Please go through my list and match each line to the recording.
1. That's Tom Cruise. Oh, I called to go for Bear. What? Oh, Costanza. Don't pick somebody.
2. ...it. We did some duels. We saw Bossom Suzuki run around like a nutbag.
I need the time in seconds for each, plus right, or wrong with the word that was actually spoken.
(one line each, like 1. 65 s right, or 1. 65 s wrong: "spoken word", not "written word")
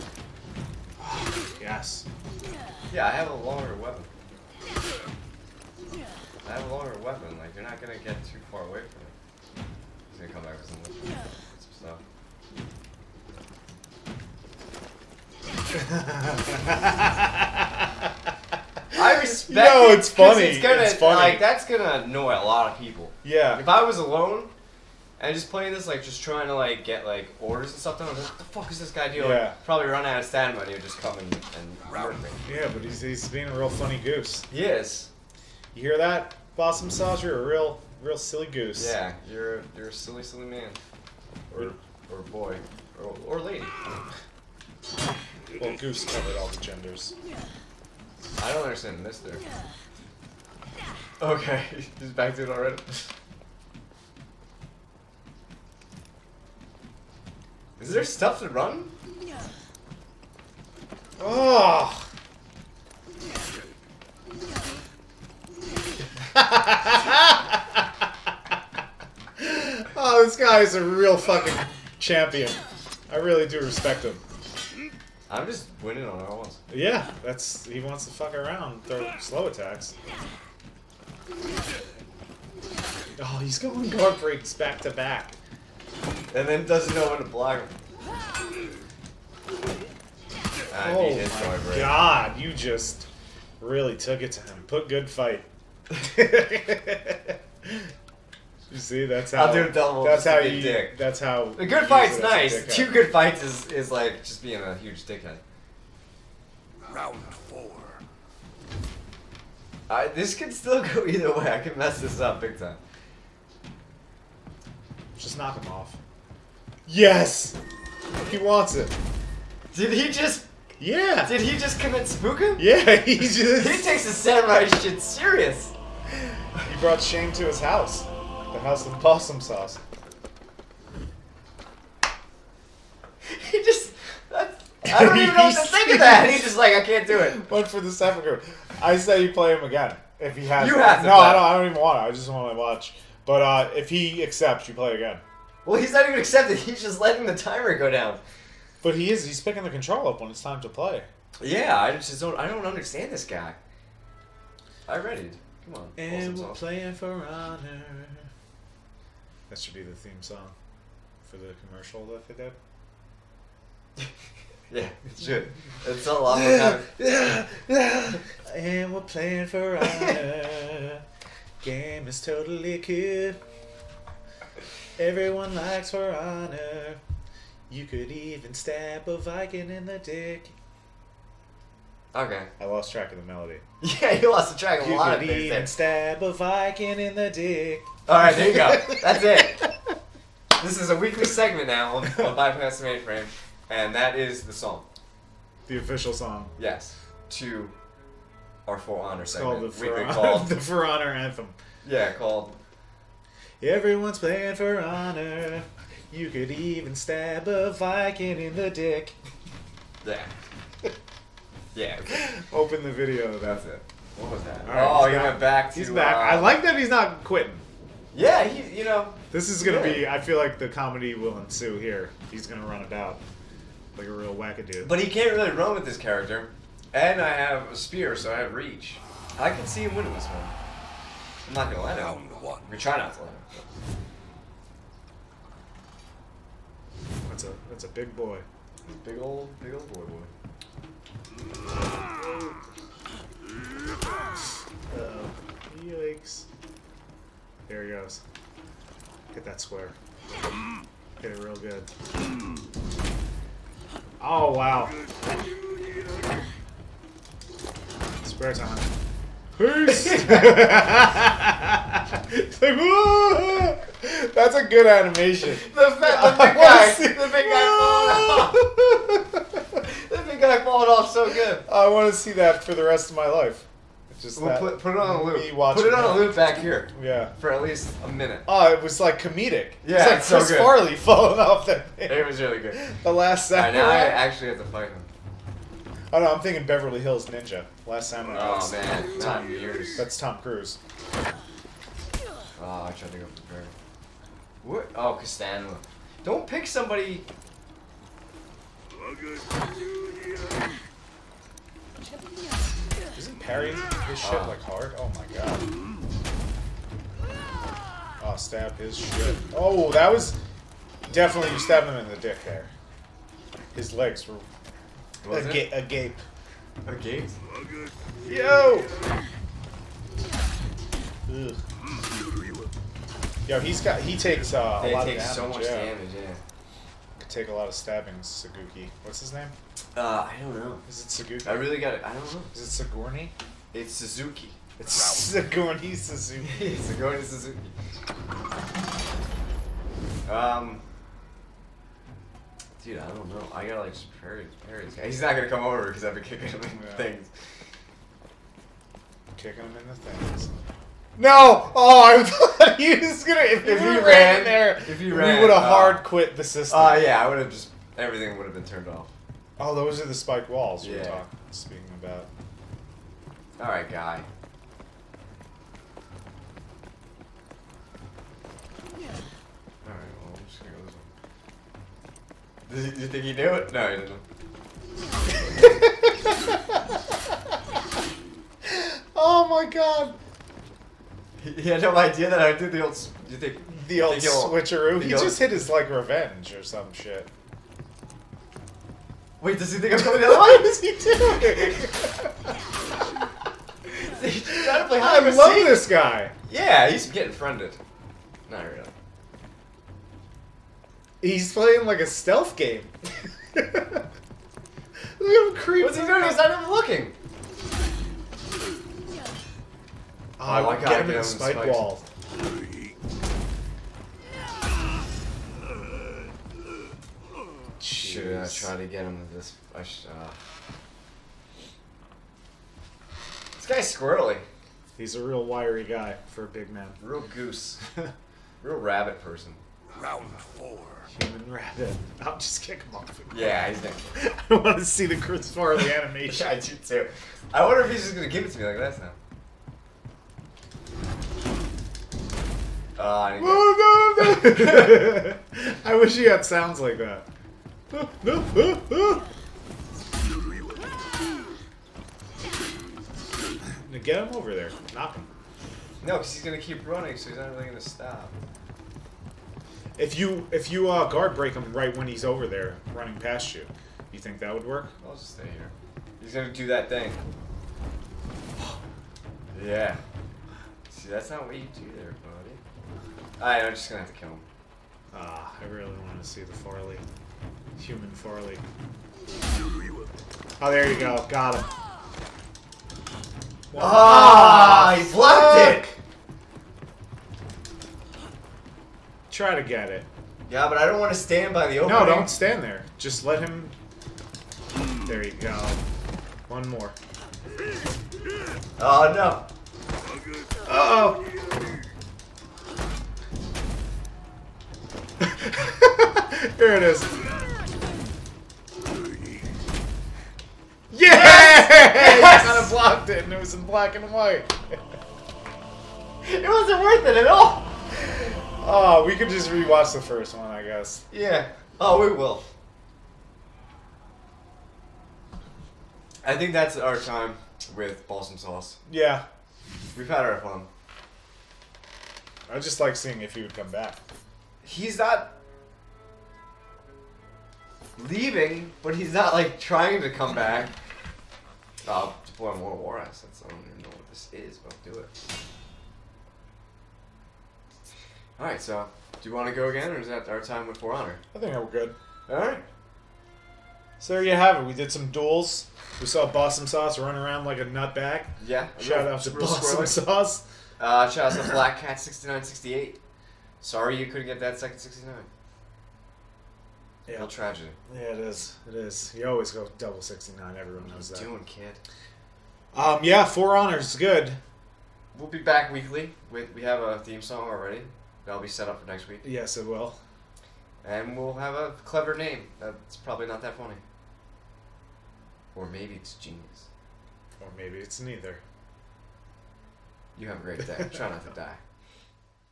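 1. 289 s wrong: "tried", not "called"
2. 554 s wrong: "Sauce", not "Suzuki".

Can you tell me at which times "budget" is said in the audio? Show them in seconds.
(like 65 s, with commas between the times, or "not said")
not said.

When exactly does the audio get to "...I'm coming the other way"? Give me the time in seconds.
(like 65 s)
389 s.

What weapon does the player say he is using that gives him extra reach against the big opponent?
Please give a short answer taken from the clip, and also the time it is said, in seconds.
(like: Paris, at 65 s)
a spear, at 227 s.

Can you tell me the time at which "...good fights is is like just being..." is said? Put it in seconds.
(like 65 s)
102 s.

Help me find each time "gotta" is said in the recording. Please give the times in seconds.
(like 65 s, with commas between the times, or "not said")
343 s, 410 s.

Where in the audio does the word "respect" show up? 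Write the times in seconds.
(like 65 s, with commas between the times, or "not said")
19 s, 73 s.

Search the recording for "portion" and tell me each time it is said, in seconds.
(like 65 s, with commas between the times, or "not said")
not said.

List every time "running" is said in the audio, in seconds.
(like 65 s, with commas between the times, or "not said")
456 s, 462 s.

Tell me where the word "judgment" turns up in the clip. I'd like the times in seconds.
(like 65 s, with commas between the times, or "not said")
not said.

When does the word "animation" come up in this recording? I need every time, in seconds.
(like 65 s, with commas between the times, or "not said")
264 s, 435 s.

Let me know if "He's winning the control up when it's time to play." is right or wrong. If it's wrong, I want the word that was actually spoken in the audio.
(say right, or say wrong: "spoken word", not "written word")
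wrong: "picking", not "winning".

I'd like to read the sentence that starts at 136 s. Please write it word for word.
He's just like, I can't do it.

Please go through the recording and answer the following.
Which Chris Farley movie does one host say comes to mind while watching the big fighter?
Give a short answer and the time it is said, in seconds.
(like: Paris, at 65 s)
Beverly Hills Ninja, at 286 s.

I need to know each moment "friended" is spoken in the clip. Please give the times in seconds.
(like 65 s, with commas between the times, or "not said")
397 s.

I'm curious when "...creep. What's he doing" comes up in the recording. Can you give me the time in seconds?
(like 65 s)
405 s.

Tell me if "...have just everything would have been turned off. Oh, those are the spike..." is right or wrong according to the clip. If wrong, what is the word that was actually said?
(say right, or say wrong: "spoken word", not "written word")
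right.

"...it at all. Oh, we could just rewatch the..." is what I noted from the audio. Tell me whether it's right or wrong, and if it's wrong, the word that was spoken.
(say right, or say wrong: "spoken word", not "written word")
right.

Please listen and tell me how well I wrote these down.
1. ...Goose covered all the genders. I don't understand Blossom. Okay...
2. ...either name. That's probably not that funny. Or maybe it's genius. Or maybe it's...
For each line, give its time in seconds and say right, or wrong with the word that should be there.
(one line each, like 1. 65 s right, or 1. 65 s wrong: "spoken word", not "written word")
1. 45 s wrong: "Mister", not "Blossom"
2. 581 s wrong: "clever", not "either".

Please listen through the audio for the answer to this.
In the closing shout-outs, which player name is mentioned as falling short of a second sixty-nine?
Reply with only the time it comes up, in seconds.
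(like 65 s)
561 s.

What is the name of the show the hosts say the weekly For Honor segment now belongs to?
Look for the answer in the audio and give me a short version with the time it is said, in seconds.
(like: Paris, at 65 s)
Bypass the Mainframe, at 192 s.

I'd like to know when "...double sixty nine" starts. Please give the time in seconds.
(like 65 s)
569 s.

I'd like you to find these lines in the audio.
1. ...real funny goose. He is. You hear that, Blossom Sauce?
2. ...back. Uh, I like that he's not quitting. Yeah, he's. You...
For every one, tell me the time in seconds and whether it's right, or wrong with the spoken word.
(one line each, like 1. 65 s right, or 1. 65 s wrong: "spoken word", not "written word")
1. 33 s right
2. 215 s right.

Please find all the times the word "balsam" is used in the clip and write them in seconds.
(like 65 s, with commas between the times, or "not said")
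528 s.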